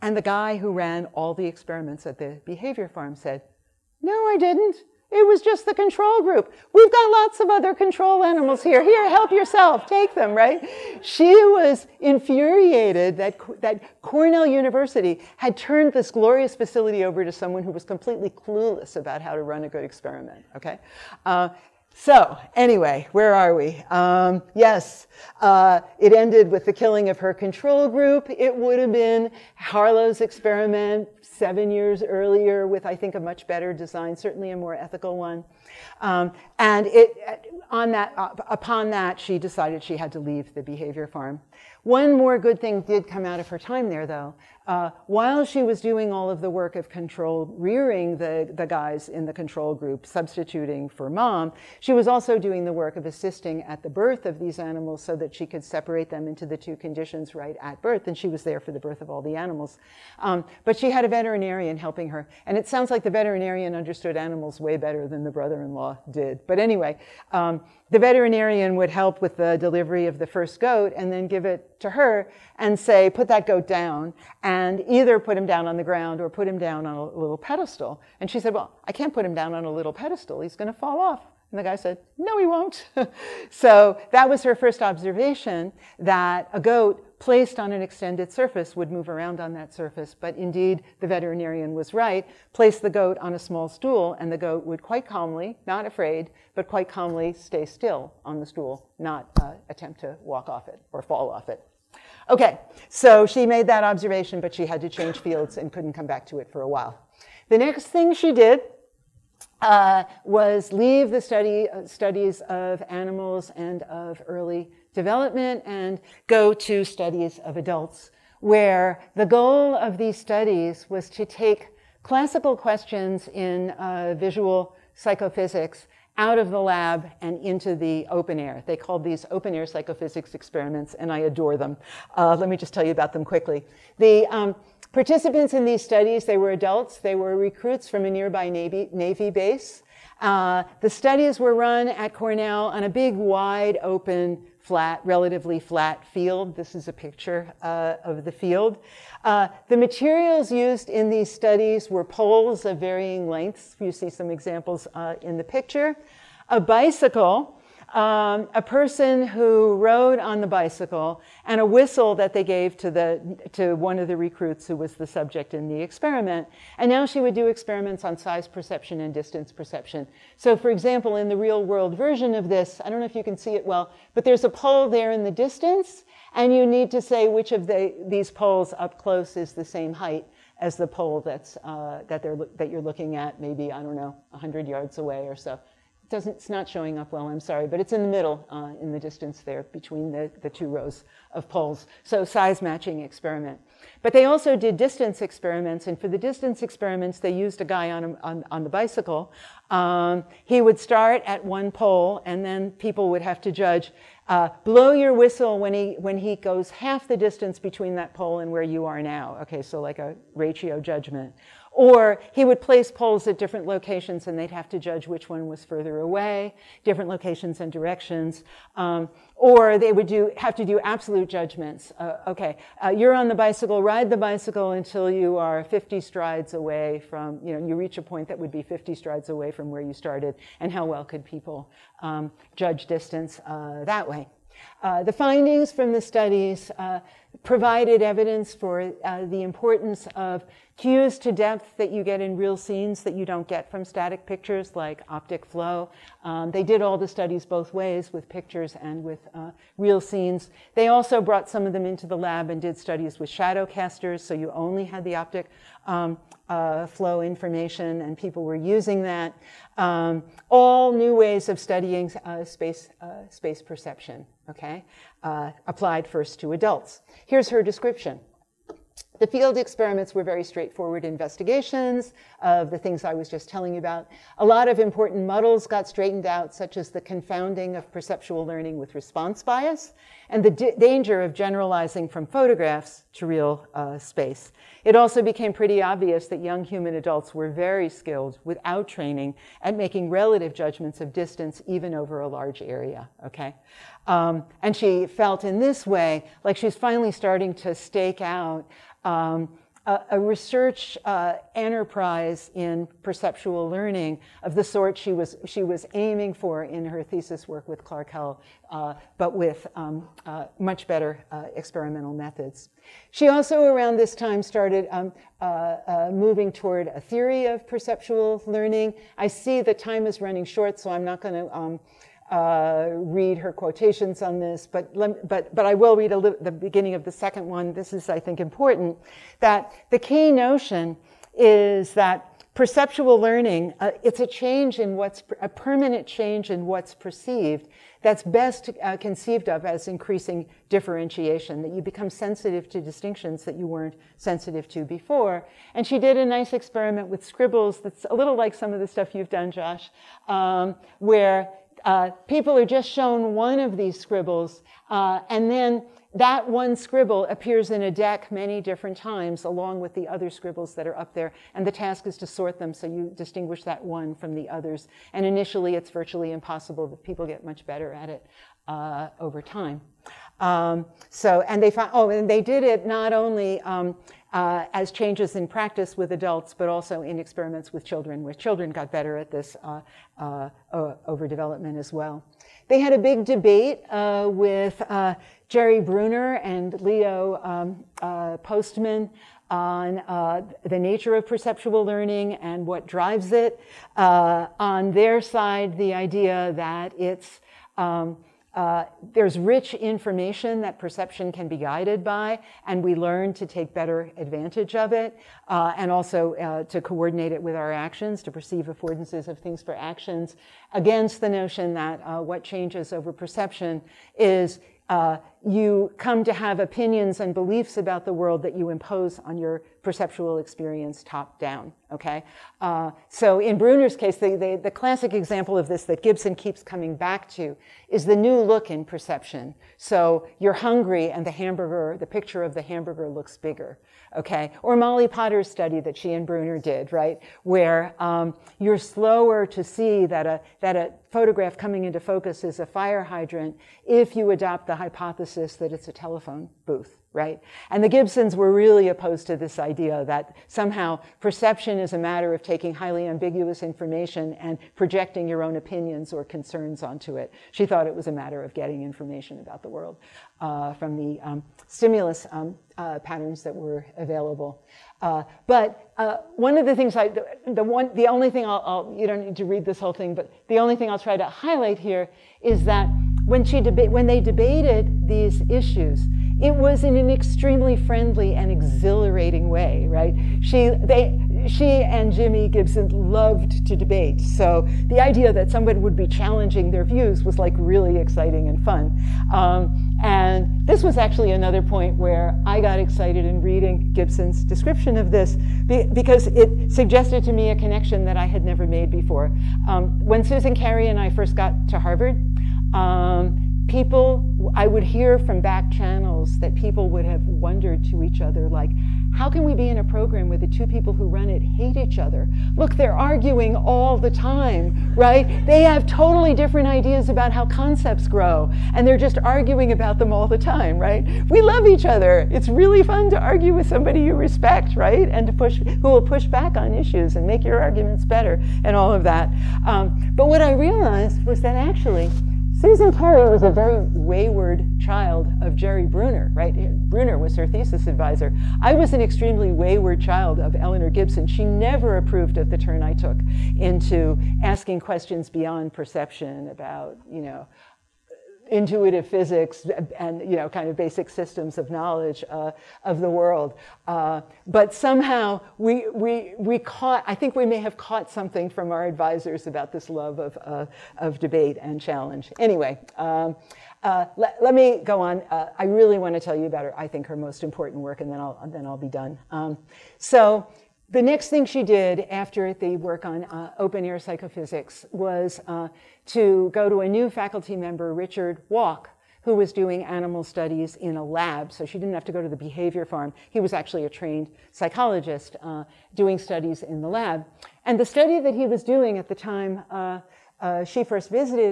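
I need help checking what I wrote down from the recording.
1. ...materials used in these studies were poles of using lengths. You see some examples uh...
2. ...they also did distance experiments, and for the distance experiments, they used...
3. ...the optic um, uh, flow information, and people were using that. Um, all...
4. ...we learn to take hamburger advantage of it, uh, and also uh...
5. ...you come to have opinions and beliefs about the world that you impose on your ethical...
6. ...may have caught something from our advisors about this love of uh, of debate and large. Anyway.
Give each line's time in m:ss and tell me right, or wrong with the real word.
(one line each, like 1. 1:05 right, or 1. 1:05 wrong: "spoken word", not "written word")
1. 2:29 wrong: "varying", not "using"
2. 3:14 right
3. 4:15 right
4. 6:42 wrong: "better", not "hamburger"
5. 6:55 wrong: "perceptual", not "ethical"
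6. 9:17 wrong: "challenge", not "large".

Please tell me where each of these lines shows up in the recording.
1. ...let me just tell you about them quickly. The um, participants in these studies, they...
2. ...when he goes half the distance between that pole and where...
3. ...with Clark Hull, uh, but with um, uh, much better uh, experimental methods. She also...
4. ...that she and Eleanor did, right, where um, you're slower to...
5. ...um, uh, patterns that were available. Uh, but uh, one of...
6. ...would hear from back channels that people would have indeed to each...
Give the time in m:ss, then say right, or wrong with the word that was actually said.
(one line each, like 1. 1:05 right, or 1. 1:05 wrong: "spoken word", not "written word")
1. 2:12 right
2. 3:25 right
3. 5:07 right
4. 7:15 wrong: "Bruner", not "Eleanor"
5. 7:42 right
6. 8:24 wrong: "wondered", not "indeed".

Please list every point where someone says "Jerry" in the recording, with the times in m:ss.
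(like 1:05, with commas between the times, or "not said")
6:25, 8:55.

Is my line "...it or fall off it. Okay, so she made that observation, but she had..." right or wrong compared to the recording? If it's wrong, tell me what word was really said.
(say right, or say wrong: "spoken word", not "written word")
right.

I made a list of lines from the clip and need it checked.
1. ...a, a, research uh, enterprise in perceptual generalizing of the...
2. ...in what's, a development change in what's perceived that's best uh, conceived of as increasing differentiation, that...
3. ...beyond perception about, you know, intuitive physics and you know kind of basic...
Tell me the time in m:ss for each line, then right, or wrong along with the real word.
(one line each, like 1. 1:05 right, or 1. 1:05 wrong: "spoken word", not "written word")
1. 4:59 wrong: "learning", not "generalizing"
2. 5:34 wrong: "permanent", not "development"
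3. 9:05 right.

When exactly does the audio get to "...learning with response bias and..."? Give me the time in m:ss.
4:38.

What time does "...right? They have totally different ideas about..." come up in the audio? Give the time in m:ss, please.
8:34.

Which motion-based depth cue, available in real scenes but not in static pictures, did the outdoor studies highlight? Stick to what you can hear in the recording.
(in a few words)
optic flow.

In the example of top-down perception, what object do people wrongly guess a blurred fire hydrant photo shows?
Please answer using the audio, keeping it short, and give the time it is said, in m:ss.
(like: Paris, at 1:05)
a telephone booth, at 7:25.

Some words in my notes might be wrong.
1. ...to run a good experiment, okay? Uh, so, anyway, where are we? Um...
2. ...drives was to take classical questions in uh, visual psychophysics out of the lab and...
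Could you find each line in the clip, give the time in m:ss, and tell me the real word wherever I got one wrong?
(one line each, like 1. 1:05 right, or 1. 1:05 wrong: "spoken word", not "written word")
1. 0:19 right
2. 2:00 wrong: "studies", not "drives".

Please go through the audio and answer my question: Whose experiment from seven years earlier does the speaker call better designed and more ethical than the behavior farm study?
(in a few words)
Harlow.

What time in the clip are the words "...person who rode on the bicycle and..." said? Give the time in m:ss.
2:38.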